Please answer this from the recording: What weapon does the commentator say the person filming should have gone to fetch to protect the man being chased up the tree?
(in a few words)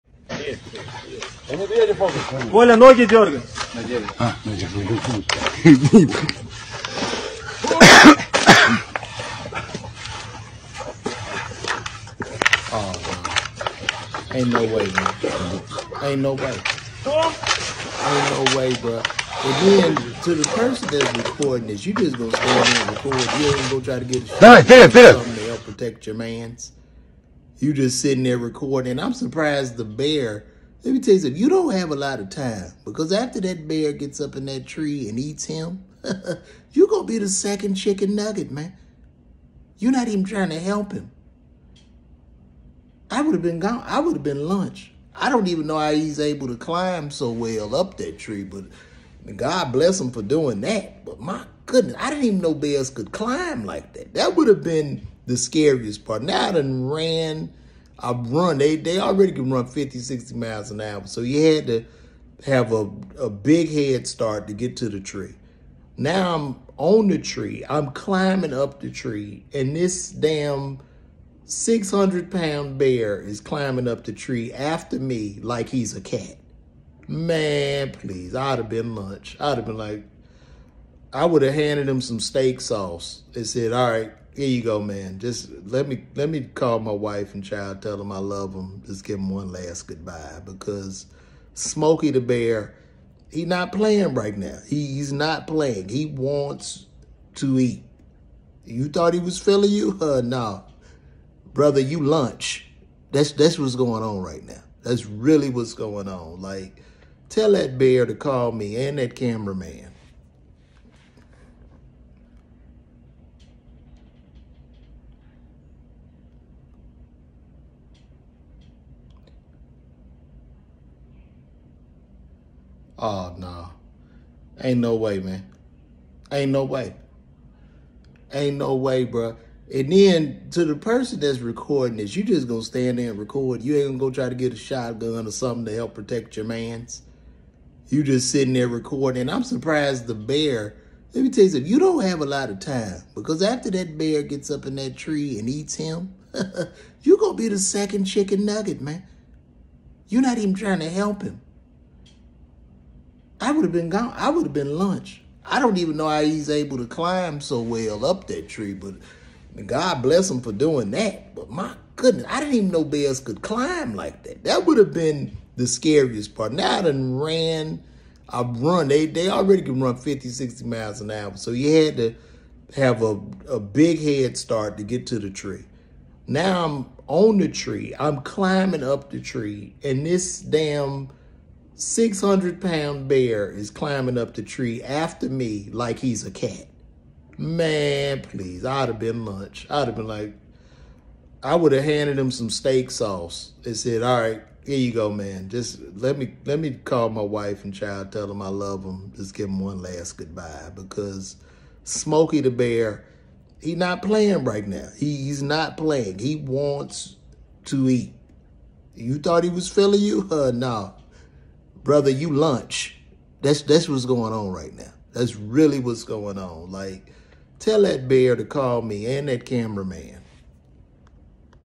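shotgun.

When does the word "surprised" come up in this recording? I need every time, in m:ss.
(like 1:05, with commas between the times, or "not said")
0:29, 2:19.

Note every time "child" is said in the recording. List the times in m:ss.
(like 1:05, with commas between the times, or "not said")
1:27, 3:17.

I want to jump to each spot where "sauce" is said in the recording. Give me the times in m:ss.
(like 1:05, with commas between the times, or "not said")
1:22, 3:12.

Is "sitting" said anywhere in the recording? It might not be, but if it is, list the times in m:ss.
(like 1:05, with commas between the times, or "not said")
0:28, 2:18.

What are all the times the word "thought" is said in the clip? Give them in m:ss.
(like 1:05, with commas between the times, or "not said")
1:38, 3:29.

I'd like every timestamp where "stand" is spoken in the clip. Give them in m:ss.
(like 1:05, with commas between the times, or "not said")
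0:22, 2:12.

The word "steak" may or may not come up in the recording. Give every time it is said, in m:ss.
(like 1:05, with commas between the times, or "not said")
1:22, 3:12.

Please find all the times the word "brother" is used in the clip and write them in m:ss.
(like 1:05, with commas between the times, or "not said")
1:41, 3:31.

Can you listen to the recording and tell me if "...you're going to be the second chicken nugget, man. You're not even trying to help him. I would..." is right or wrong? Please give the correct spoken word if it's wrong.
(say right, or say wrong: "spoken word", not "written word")
right.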